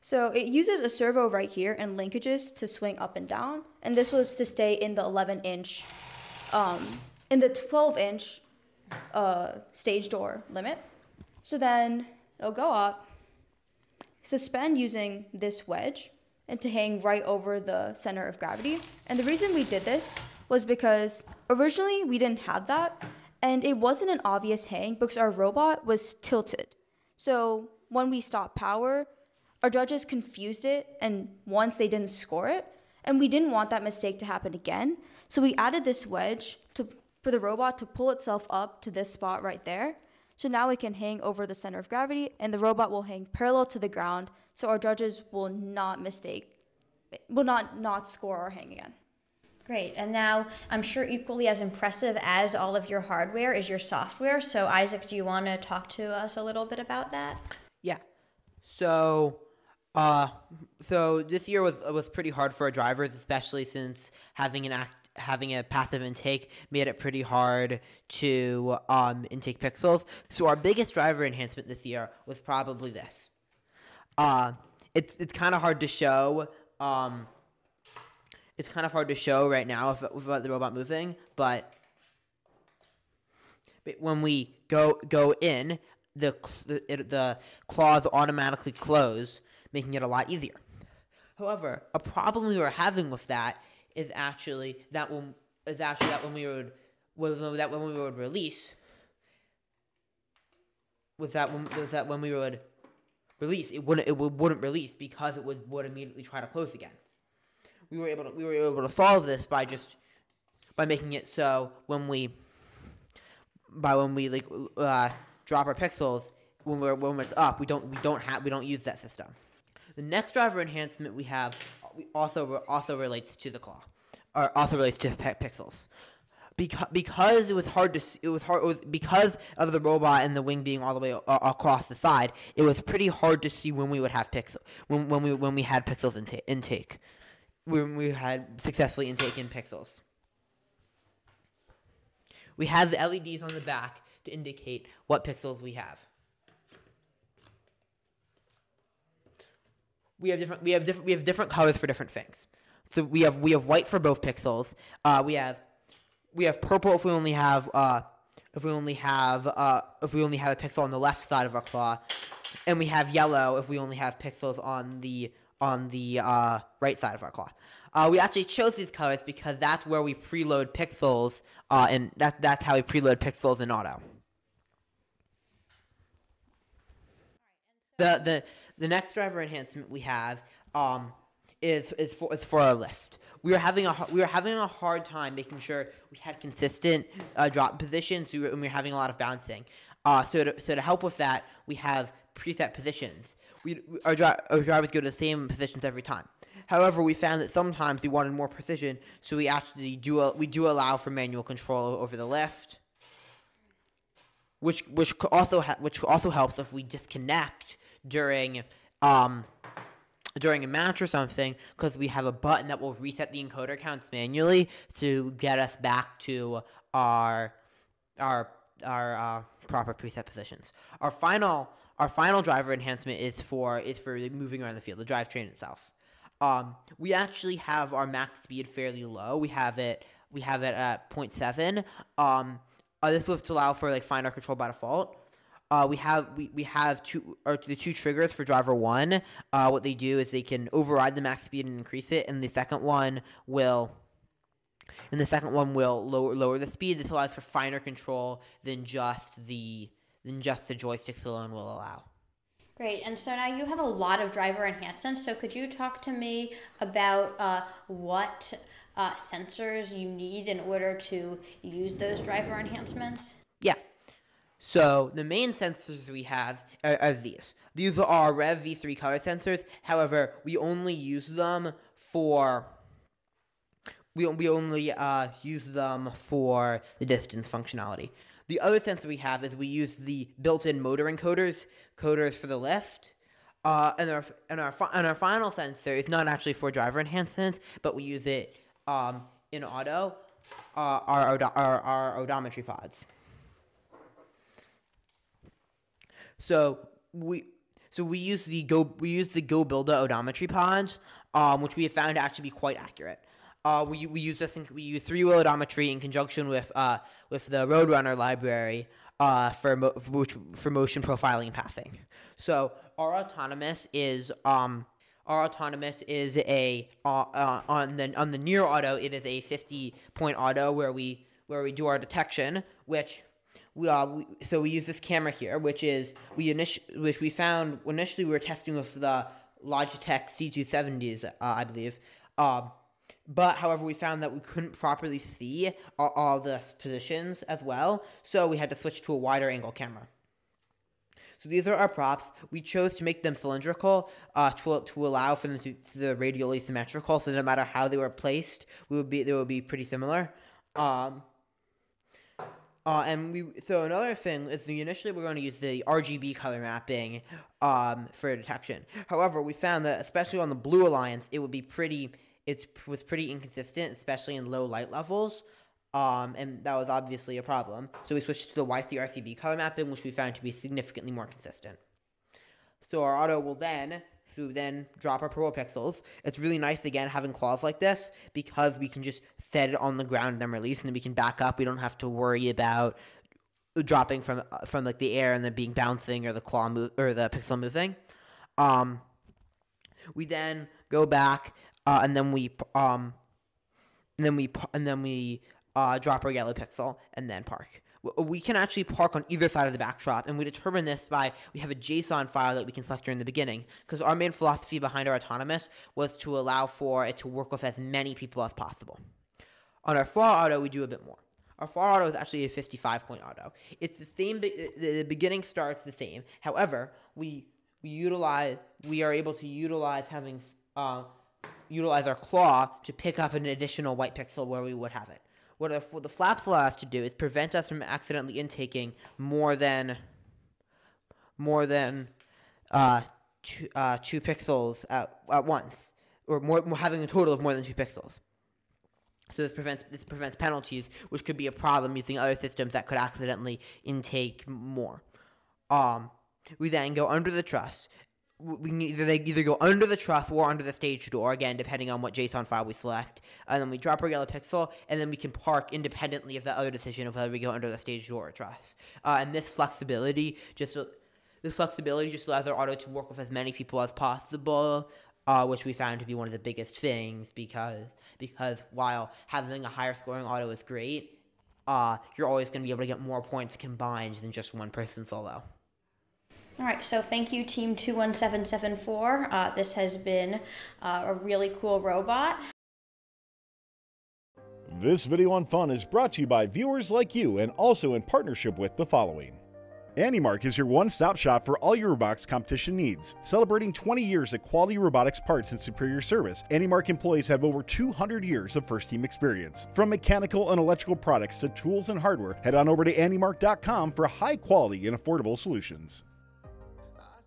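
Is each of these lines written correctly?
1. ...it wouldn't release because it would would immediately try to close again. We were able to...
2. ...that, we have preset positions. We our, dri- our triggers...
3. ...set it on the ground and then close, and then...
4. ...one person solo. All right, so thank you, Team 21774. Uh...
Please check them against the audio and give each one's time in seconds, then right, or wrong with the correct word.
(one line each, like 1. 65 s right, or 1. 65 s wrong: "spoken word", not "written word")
1. 104 s right
2. 191 s wrong: "drivers", not "triggers"
3. 379 s wrong: "release", not "close"
4. 474 s right.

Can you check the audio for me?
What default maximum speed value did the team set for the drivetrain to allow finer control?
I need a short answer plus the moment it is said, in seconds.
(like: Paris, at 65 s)
0.7, at 231 s.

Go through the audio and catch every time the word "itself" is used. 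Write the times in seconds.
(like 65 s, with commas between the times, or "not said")
38 s, 225 s.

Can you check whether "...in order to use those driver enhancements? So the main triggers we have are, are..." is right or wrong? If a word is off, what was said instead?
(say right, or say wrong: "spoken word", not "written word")
wrong: "sensors", not "triggers".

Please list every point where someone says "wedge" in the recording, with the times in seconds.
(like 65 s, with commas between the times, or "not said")
15 s, 36 s.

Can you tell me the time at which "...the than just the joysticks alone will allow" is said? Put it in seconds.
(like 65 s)
249 s.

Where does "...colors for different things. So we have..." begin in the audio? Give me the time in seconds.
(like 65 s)
151 s.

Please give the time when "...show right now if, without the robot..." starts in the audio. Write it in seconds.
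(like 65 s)
79 s.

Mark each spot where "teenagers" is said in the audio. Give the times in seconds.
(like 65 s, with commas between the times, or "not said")
not said.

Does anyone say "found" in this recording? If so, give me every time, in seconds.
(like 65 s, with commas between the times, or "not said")
197 s, 301 s, 327 s, 333 s, 359 s, 370 s, 465 s.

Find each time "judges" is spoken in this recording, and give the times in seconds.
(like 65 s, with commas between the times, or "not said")
29 s, 44 s.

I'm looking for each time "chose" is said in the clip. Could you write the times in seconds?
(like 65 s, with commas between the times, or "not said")
168 s, 342 s.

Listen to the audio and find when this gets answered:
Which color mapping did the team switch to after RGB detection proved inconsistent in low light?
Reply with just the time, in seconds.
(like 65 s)
368 s.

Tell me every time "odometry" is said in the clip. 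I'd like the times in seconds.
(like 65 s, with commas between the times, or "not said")
292 s, 300 s, 305 s.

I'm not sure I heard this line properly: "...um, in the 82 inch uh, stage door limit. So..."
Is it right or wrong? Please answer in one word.
wrong.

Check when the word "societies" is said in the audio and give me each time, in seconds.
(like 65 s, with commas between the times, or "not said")
not said.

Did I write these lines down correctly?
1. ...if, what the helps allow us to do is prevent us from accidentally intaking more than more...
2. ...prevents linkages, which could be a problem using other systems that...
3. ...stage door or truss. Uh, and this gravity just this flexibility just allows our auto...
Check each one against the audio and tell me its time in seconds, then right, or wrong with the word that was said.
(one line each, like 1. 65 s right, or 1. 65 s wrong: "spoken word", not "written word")
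1. 425 s wrong: "flaps", not "helps"
2. 440 s wrong: "penalties", not "linkages"
3. 457 s wrong: "flexibility", not "gravity".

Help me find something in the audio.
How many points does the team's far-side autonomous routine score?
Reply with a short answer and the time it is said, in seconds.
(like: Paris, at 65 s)
55, at 412 s.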